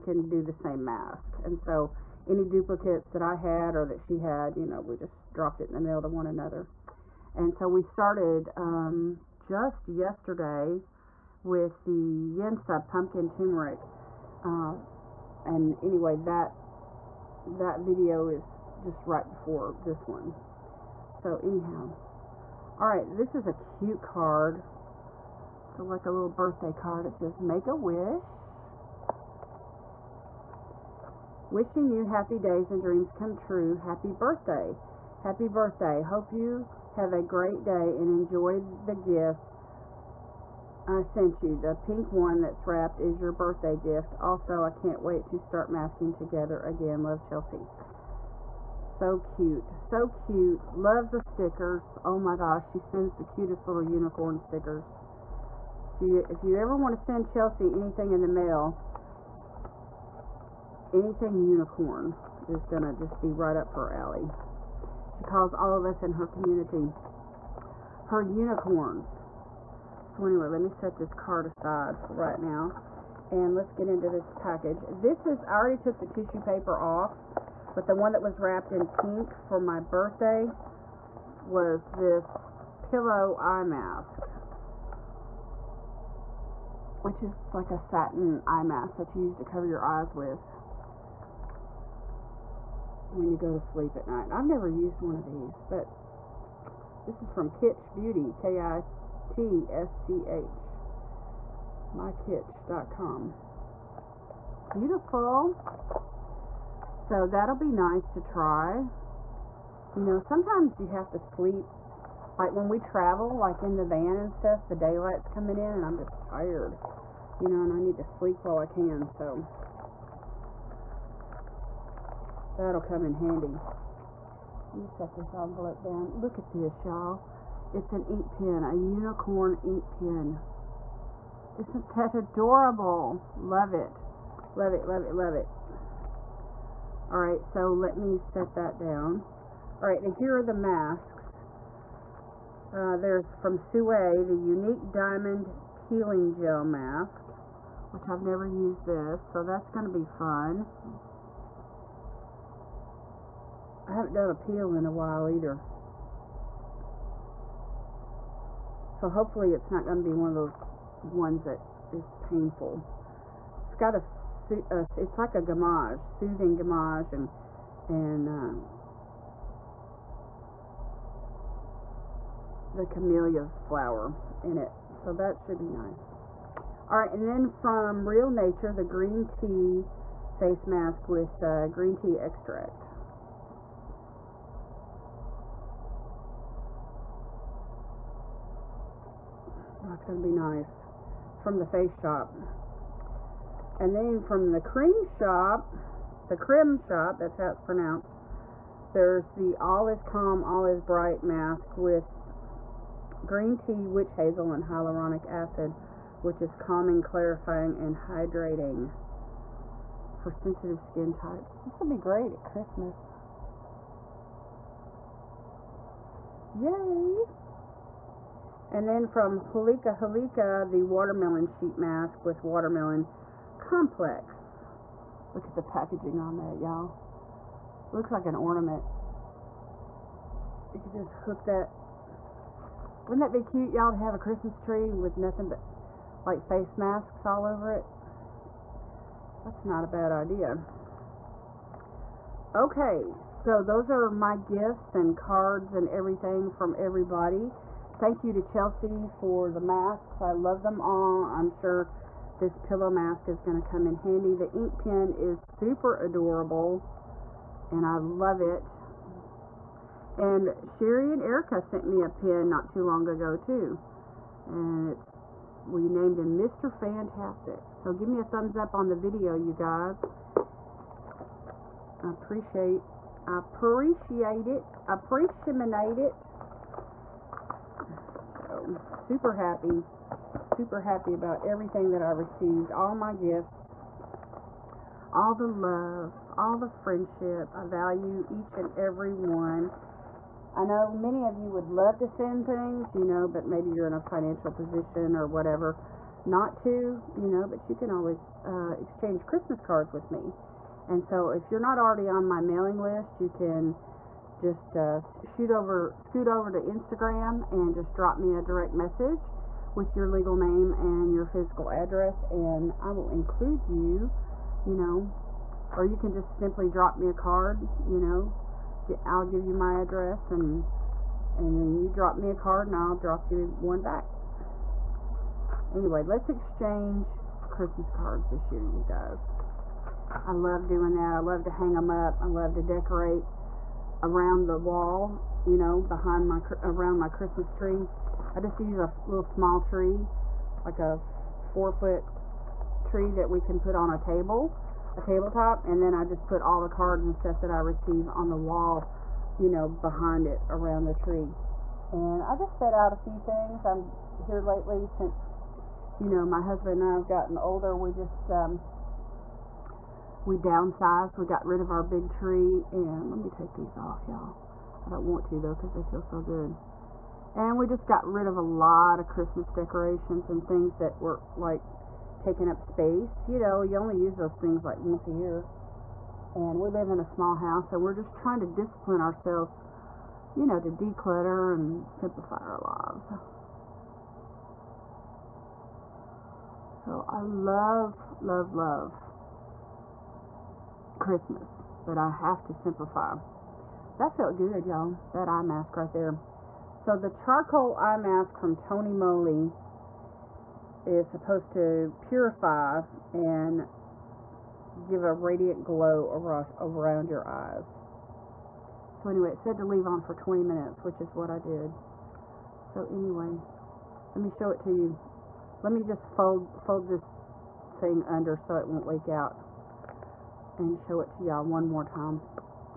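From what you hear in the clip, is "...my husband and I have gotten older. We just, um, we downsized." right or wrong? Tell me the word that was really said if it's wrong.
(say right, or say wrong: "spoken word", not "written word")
right.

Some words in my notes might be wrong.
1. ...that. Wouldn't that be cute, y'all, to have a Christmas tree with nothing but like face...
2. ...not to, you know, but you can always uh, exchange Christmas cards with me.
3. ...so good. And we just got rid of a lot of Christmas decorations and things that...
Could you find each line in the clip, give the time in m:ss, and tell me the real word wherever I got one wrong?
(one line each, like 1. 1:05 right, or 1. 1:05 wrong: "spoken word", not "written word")
1. 3:51 right
2. 4:56 right
3. 6:06 right.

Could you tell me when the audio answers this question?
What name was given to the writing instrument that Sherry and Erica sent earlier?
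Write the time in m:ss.
4:26.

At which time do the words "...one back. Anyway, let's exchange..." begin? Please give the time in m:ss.
5:23.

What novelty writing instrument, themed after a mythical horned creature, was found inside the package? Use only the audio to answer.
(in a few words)
unicorn ink pen.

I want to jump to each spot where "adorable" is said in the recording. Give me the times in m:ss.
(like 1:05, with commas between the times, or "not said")
2:12, 4:15.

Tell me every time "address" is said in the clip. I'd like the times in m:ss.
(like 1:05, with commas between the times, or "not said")
5:11, 5:19.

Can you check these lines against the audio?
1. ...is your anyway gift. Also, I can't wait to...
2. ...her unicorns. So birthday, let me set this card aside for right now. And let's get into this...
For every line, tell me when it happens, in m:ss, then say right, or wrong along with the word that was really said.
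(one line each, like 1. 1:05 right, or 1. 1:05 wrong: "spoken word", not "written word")
1. 0:42 wrong: "birthday", not "anyway"
2. 1:08 wrong: "anyway", not "birthday".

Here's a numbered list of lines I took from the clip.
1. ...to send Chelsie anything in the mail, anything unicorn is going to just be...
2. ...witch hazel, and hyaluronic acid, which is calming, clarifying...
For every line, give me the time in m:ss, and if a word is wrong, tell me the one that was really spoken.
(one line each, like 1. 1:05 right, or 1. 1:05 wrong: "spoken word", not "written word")
1. 0:56 right
2. 3:23 right.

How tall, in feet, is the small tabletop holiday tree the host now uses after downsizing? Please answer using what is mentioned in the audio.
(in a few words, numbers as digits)
4.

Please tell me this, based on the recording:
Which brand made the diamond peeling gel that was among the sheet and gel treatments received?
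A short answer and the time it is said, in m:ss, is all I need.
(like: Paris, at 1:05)
Sue, at 2:23.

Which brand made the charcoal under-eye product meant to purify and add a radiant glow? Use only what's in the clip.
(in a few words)
Tony Moly.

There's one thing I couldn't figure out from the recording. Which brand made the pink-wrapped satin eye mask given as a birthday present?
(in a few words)
Kitsch Beauty.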